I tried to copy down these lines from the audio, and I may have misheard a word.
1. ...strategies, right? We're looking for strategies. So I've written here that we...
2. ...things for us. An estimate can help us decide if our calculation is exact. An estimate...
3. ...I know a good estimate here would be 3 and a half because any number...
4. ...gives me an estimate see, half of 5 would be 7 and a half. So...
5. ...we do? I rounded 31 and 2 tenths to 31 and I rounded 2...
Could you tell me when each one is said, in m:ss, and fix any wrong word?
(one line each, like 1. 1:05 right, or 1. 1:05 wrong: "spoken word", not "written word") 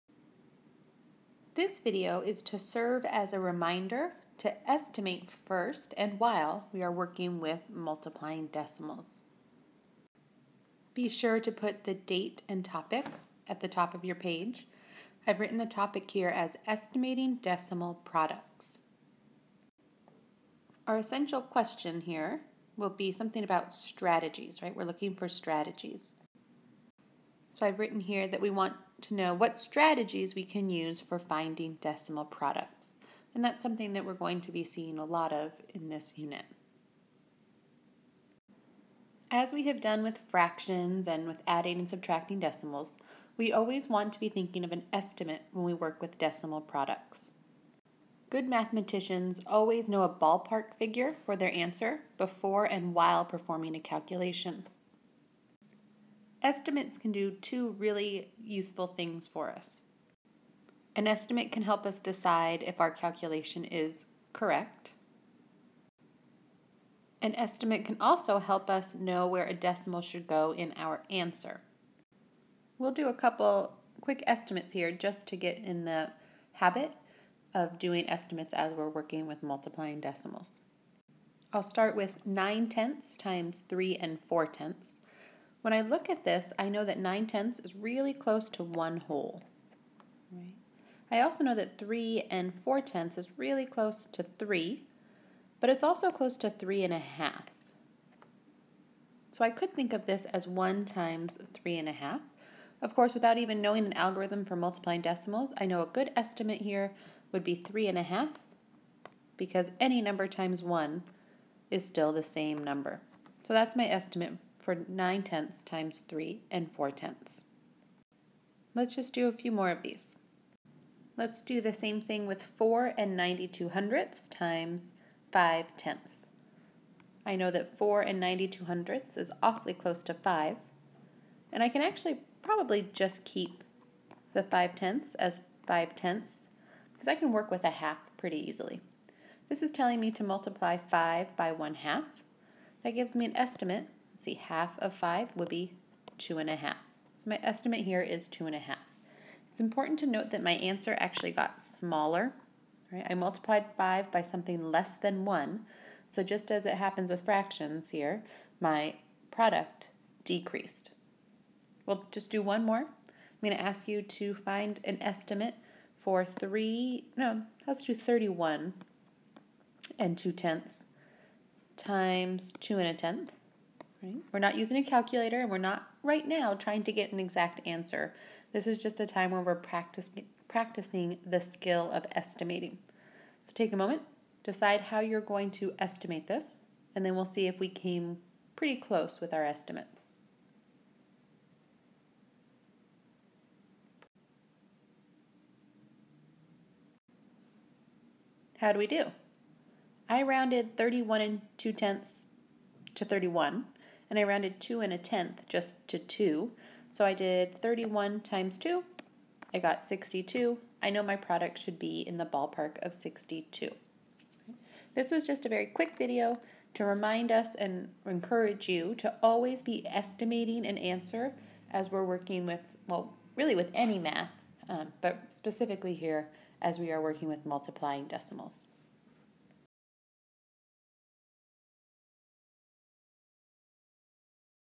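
1. 0:23 right
2. 0:58 wrong: "correct", not "exact"
3. 1:45 right
4. 2:22 wrong: "2", not "7"
5. 3:18 right.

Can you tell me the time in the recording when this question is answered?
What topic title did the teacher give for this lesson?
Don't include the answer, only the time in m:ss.
0:16.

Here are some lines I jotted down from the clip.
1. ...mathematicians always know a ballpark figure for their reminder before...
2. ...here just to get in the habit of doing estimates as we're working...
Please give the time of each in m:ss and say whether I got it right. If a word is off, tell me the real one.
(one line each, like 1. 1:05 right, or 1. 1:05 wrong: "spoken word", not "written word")
1. 0:48 wrong: "answer", not "reminder"
2. 1:14 right.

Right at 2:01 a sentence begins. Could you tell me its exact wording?
Let's do the same thing with 4 and 92 hundredths times 5 tenths.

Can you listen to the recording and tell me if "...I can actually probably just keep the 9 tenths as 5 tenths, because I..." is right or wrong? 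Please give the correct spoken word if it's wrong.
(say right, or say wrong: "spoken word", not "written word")
wrong: "5", not "9".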